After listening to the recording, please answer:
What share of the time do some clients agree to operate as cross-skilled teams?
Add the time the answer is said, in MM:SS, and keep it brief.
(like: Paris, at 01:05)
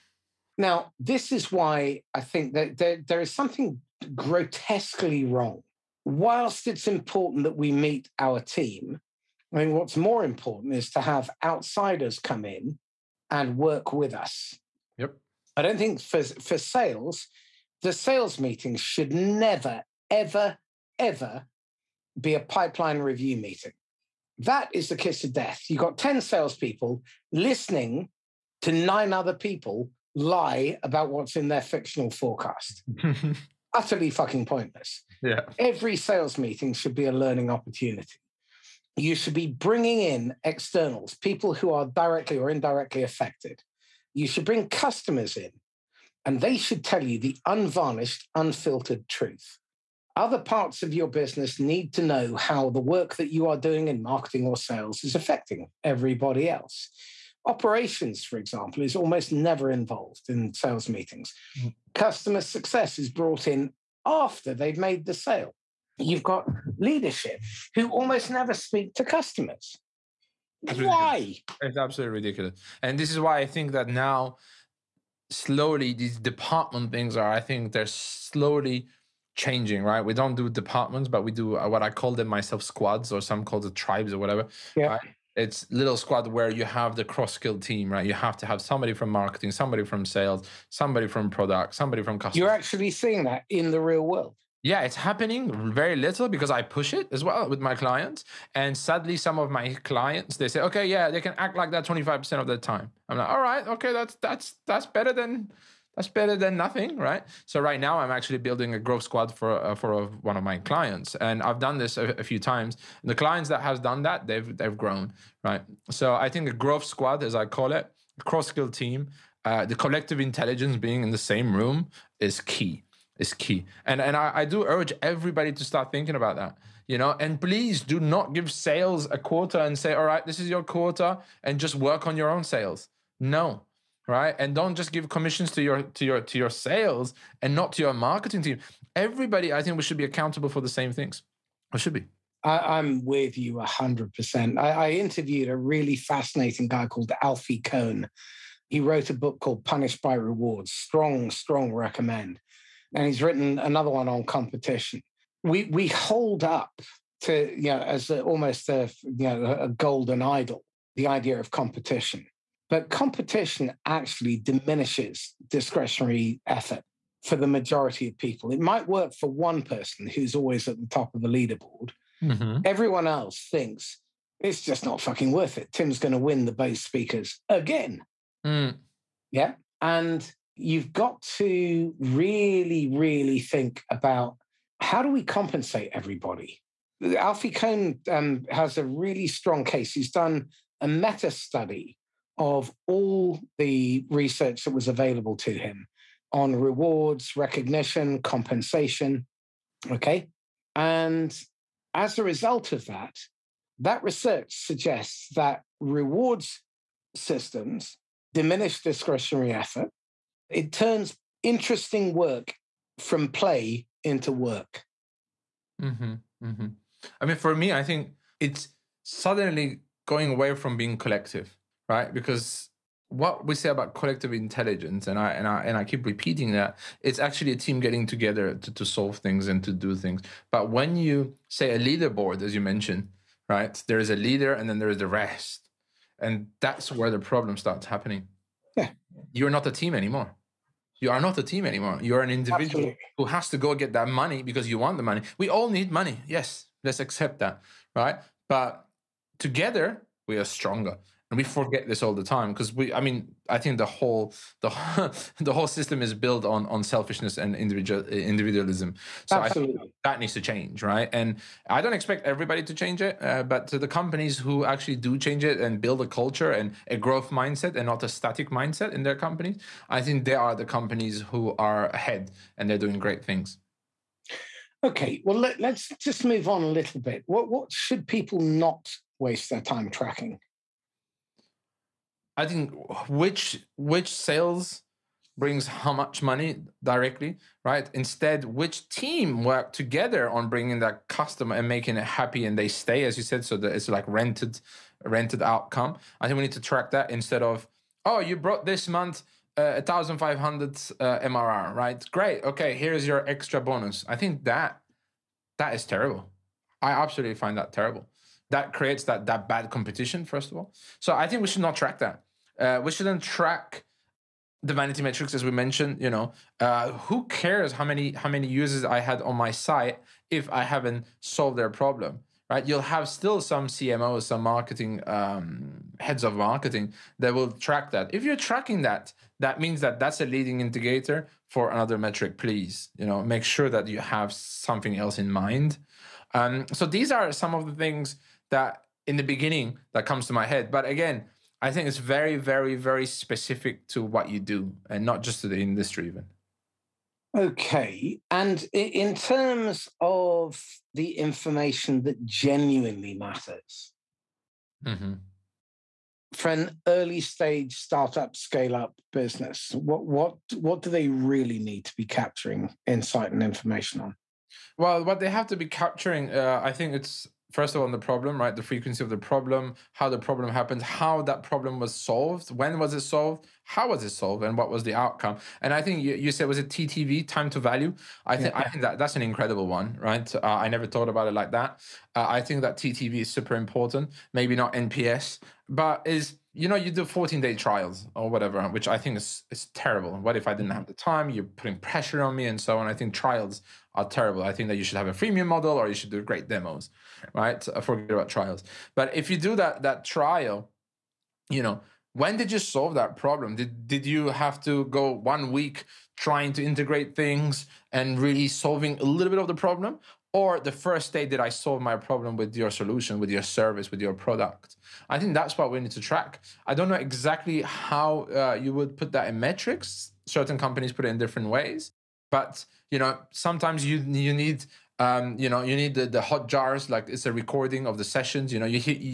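25%, at 01:41.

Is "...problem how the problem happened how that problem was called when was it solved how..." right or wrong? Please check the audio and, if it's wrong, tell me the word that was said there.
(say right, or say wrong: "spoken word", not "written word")
wrong: "solved", not "called".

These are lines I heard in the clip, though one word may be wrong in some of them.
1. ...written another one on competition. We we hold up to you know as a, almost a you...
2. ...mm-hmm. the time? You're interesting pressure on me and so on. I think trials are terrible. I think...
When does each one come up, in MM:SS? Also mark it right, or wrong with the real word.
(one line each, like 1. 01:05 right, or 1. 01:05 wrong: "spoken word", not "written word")
1. 02:33 right
2. 06:30 wrong: "putting", not "interesting".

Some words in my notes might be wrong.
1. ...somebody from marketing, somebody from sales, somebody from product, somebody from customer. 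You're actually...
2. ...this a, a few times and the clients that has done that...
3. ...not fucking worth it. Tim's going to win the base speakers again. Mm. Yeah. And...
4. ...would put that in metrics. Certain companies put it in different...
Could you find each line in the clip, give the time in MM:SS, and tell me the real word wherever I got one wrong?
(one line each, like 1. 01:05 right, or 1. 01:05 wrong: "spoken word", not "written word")
1. 01:28 right
2. 01:51 right
3. 02:54 right
4. 06:58 right.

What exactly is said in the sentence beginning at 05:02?
Great, okay, here's your extra bonus.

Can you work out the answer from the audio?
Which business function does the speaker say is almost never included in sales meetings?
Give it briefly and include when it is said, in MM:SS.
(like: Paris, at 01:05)
Operations, at 00:57.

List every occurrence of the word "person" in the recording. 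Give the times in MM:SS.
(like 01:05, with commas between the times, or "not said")
02:49.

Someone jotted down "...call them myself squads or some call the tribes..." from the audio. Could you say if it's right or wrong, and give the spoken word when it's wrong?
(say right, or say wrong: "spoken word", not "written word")
right.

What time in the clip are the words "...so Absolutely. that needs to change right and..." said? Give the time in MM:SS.
04:19.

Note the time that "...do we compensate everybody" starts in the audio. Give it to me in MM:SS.
03:05.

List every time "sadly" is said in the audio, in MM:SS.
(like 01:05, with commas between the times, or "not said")
01:38.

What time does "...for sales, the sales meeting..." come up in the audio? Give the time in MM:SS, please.
00:16.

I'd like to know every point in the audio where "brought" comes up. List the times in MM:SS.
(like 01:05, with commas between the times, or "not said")
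01:03, 04:58.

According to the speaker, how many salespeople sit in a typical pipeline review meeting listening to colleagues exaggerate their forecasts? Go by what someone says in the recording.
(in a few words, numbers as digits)
10.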